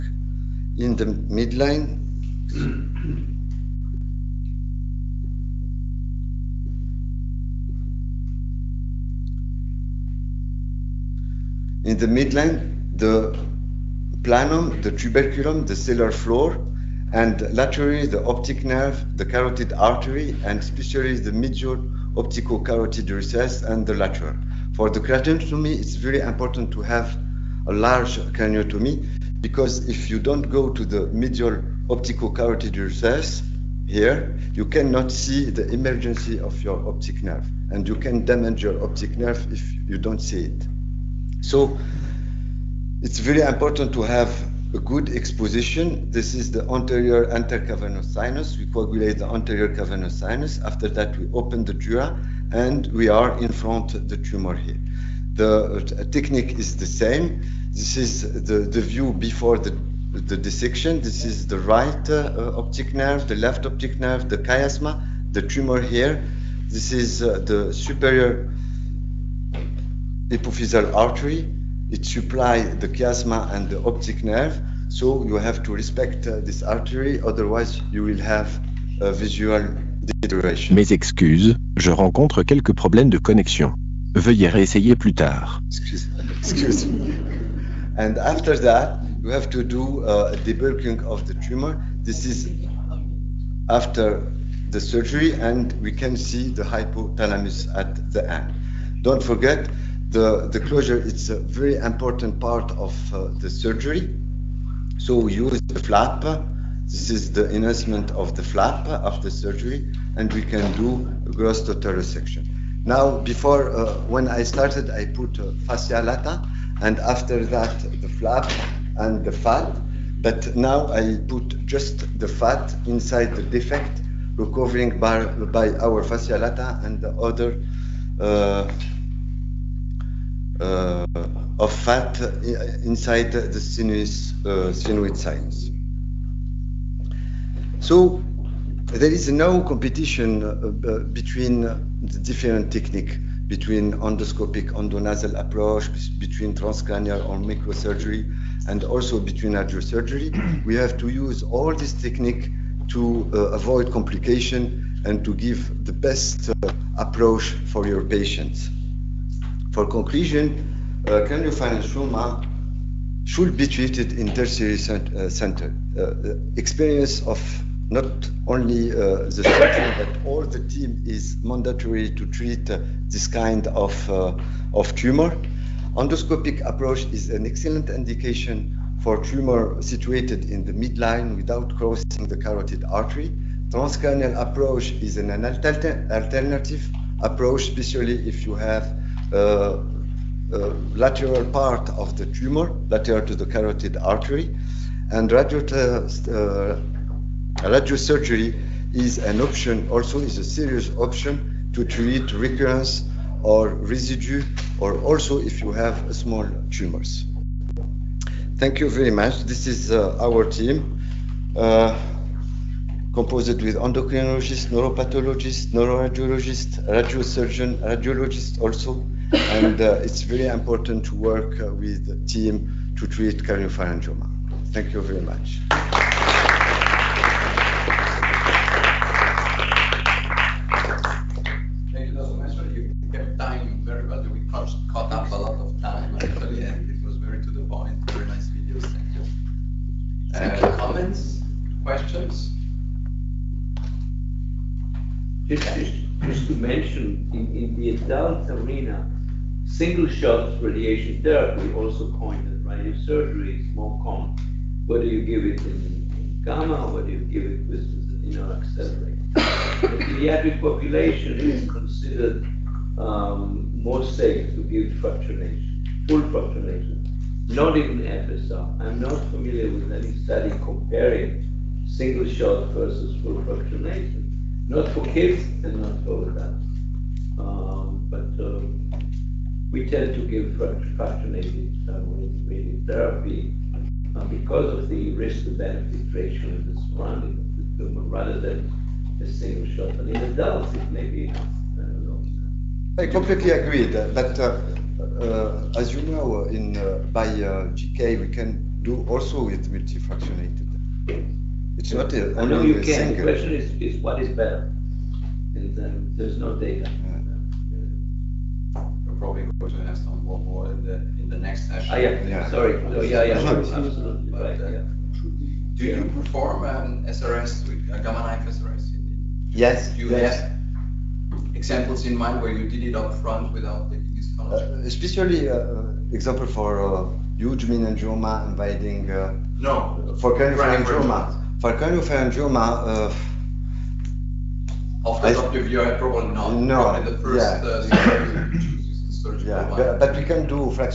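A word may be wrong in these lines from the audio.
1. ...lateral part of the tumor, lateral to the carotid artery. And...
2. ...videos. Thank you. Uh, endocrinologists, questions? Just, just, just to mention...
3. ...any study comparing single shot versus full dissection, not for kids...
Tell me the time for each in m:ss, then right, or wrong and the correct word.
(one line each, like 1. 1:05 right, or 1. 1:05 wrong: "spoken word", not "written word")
1. 3:10 right
2. 3:58 wrong: "comments", not "endocrinologists"
3. 4:29 wrong: "fractionation", not "dissection".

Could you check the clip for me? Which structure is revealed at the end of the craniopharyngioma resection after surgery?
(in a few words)
Hypothalamus.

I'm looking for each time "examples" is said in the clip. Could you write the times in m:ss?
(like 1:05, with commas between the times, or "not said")
5:21, 5:26.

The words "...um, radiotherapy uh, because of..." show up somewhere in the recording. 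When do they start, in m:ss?
4:41.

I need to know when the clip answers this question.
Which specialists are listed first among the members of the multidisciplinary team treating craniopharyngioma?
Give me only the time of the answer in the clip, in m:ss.
3:33.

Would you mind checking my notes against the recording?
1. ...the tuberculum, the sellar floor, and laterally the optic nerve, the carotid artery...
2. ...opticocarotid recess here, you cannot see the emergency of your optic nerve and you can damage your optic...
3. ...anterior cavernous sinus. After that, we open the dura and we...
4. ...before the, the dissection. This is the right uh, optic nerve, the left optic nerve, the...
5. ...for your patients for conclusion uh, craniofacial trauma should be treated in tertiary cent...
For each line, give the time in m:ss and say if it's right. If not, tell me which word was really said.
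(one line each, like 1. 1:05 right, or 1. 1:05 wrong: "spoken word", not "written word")
1. 0:14 right
2. 0:31 right
3. 0:49 right
4. 0:59 right
5. 2:37 right.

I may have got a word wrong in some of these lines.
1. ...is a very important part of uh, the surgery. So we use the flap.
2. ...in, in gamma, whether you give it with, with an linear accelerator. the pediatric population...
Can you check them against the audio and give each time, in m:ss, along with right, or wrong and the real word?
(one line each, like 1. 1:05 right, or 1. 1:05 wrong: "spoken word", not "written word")
1. 1:40 right
2. 4:15 right.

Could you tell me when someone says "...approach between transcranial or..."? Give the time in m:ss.
2:25.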